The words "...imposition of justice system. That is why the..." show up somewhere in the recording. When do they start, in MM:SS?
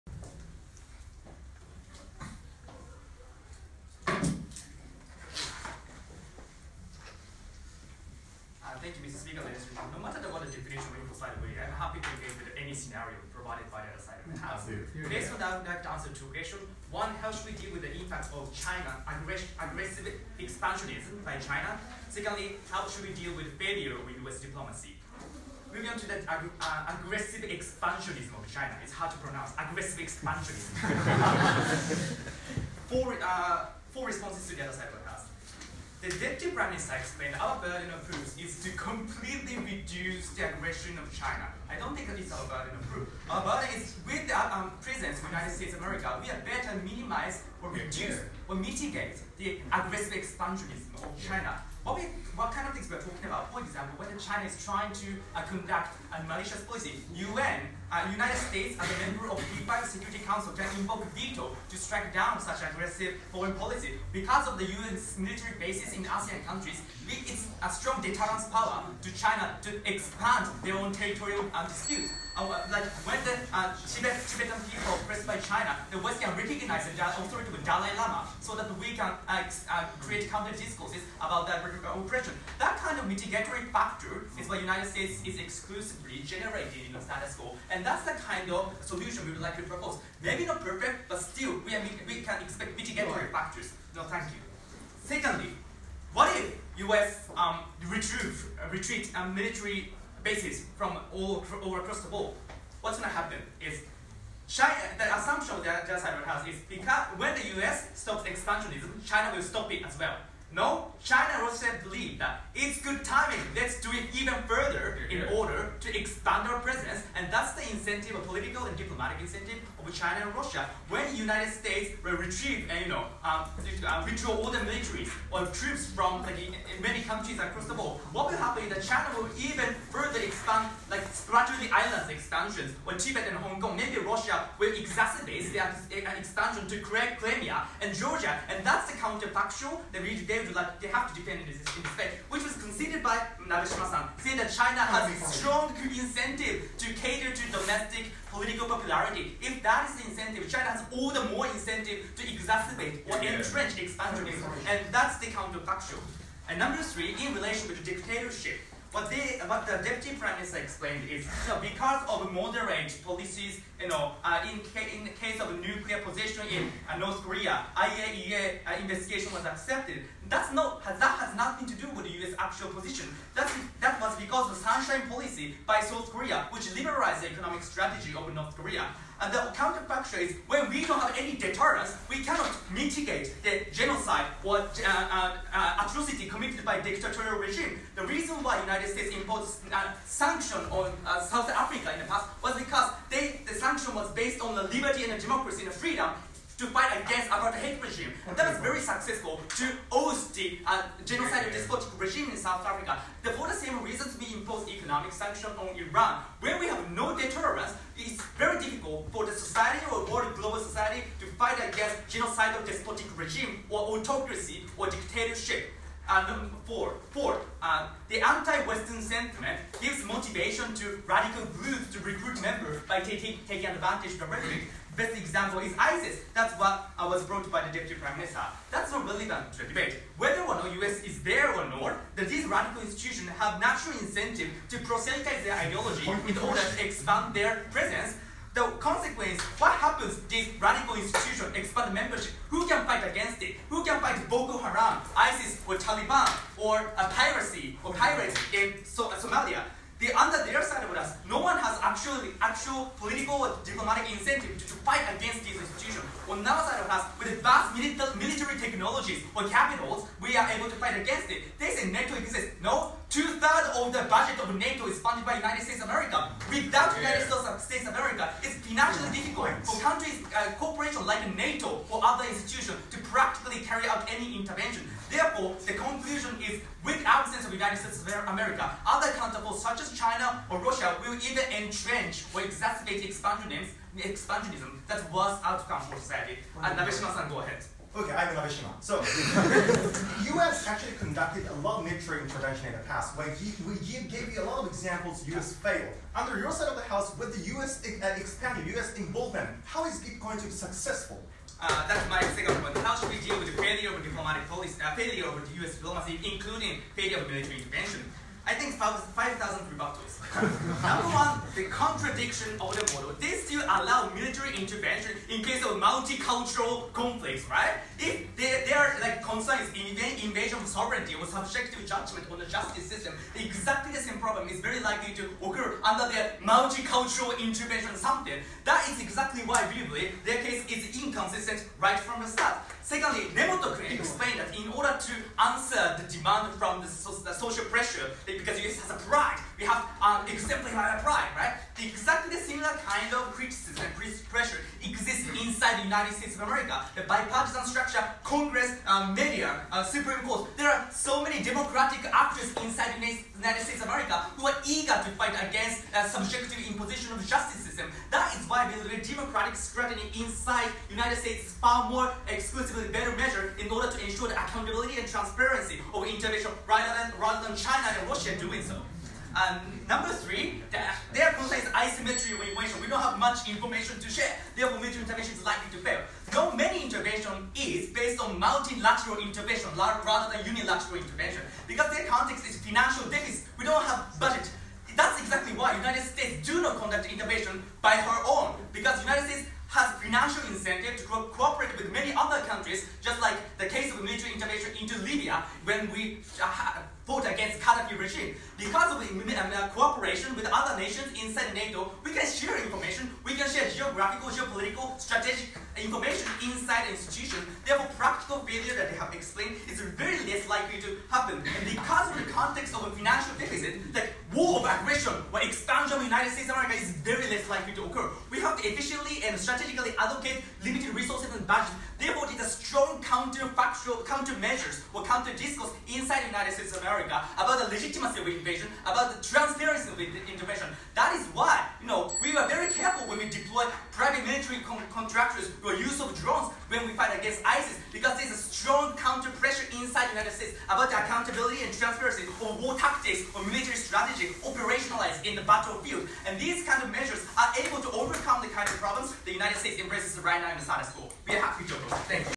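05:56.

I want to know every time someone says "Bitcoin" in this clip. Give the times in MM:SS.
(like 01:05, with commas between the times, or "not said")
04:59.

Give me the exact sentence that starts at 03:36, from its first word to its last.
And um, four, four, uh, the anti-Western sentiment gives motivation to radical groups to recruit members by taking advantage of the rhetoric.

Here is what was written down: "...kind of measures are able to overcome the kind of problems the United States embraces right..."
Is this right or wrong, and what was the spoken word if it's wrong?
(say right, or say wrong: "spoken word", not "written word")
right.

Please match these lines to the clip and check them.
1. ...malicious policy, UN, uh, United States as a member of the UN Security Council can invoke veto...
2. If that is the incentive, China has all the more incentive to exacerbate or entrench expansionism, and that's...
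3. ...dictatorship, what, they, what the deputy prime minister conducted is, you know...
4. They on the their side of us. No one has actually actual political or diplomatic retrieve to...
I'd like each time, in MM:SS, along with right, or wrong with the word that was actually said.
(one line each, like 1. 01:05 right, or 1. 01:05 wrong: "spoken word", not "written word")
1. 00:56 right
2. 02:29 right
3. 02:37 wrong: "explained", not "conducted"
4. 04:10 wrong: "incentive", not "retrieve".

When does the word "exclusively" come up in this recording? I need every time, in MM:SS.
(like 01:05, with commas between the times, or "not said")
01:25, 06:02.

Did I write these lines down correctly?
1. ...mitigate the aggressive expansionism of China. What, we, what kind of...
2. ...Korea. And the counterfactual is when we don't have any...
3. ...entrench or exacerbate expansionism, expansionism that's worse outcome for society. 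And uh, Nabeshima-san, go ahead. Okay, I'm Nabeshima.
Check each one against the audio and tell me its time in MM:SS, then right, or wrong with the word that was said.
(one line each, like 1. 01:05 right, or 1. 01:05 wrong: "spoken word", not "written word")
1. 00:48 right
2. 02:58 right
3. 04:41 right.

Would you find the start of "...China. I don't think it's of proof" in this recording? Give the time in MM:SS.
00:41.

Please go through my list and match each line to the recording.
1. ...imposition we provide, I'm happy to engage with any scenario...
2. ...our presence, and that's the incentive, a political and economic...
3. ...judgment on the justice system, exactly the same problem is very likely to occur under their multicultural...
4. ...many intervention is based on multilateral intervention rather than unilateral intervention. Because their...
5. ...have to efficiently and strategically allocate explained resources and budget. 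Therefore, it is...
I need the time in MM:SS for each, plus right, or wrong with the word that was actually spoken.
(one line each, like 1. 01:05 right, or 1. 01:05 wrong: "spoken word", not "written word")
1. 00:10 wrong: "definition", not "imposition"
2. 01:56 wrong: "diplomatic", not "economic"
3. 05:21 right
4. 06:16 right
5. 06:58 wrong: "limited", not "explained".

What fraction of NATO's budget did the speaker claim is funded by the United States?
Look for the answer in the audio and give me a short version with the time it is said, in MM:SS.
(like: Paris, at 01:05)
Two-thirds, at 04:23.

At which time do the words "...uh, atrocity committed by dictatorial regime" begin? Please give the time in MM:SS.
03:05.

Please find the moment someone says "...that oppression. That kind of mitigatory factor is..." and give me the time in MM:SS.
01:21.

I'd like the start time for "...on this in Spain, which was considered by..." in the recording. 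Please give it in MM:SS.
02:21.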